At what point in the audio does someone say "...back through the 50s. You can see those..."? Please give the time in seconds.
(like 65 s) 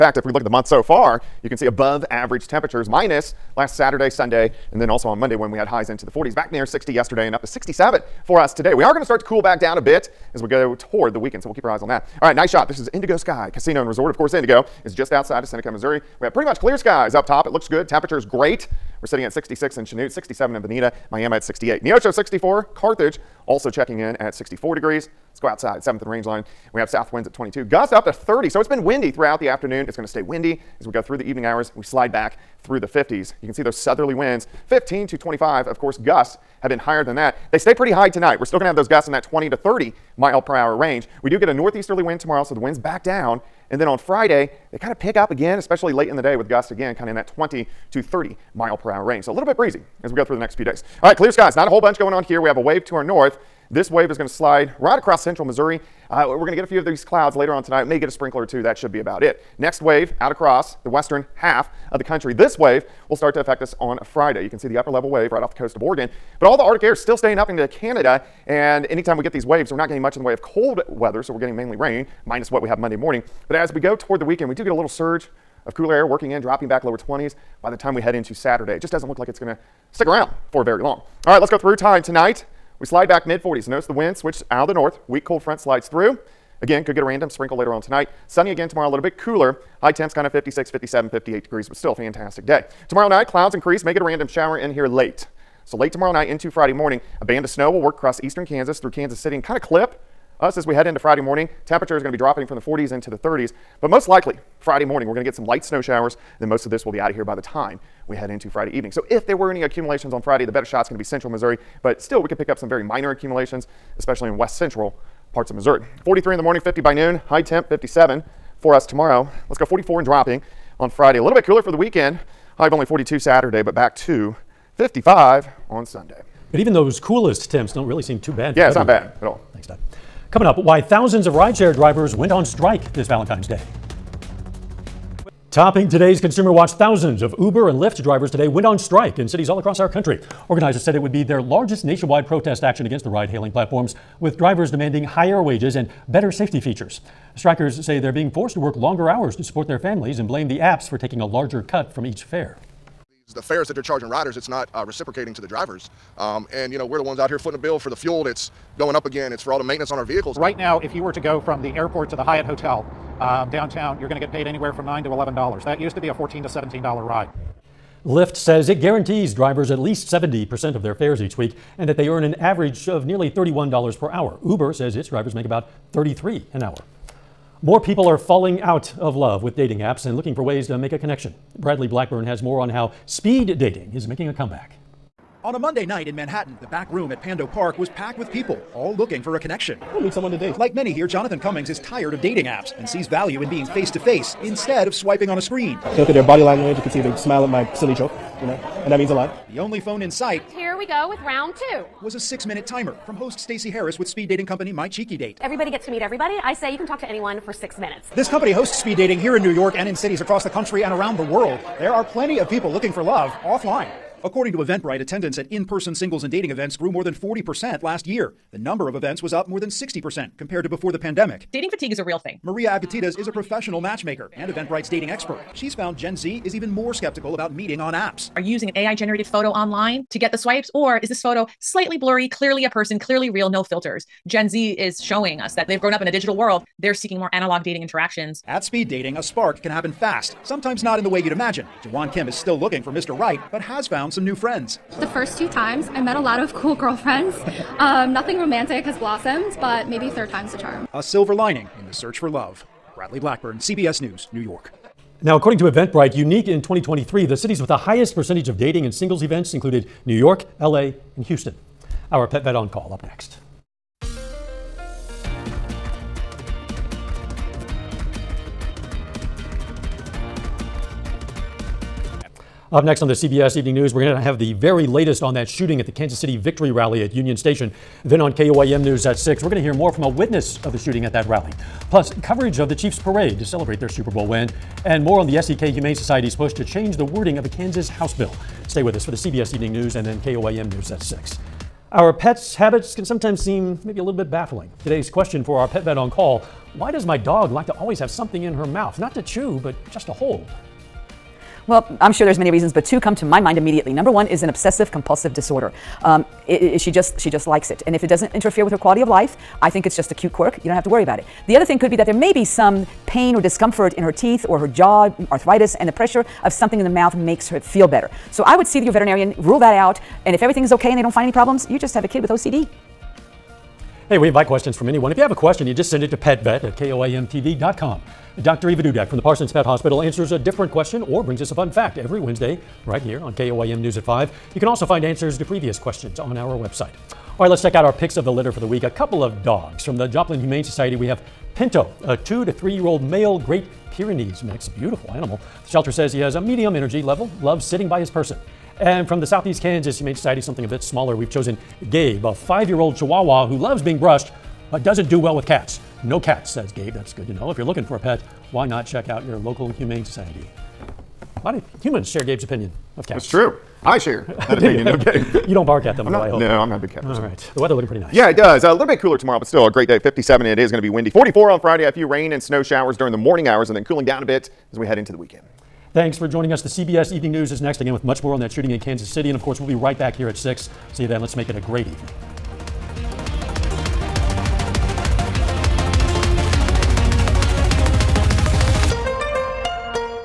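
32 s.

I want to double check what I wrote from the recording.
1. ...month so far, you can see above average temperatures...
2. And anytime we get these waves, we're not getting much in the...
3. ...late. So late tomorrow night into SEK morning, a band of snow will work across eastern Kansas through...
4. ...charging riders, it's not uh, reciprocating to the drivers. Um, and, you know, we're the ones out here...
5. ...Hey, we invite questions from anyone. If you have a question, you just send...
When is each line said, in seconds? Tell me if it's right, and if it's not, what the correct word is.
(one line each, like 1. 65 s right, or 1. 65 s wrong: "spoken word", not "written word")
1. 0 s right
2. 68 s right
3. 94 s wrong: "Friday", not "SEK"
4. 153 s right
5. 324 s right.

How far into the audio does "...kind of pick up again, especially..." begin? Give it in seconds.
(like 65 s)
44 s.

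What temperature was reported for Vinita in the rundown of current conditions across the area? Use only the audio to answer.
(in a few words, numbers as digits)
67.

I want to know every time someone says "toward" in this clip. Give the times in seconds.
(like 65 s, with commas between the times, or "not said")
10 s, 73 s.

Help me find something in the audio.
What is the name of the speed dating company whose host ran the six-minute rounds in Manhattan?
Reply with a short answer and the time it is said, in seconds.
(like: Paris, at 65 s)
My Cheeky Date, at 204 s.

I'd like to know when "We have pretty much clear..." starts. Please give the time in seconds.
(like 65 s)
16 s.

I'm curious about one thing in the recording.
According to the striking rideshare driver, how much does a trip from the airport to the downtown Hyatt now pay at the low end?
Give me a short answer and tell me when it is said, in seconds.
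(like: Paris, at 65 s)
$9, at 164 s.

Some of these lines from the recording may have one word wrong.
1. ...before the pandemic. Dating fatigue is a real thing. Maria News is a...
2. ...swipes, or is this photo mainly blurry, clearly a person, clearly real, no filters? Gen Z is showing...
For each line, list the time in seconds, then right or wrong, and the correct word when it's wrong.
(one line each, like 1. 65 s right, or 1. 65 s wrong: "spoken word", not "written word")
1. 220 s wrong: "Avgitidis", not "News"
2. 230 s wrong: "slightly", not "mainly".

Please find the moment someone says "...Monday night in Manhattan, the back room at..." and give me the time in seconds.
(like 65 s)
185 s.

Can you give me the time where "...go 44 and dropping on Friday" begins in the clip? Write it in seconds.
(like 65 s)
119 s.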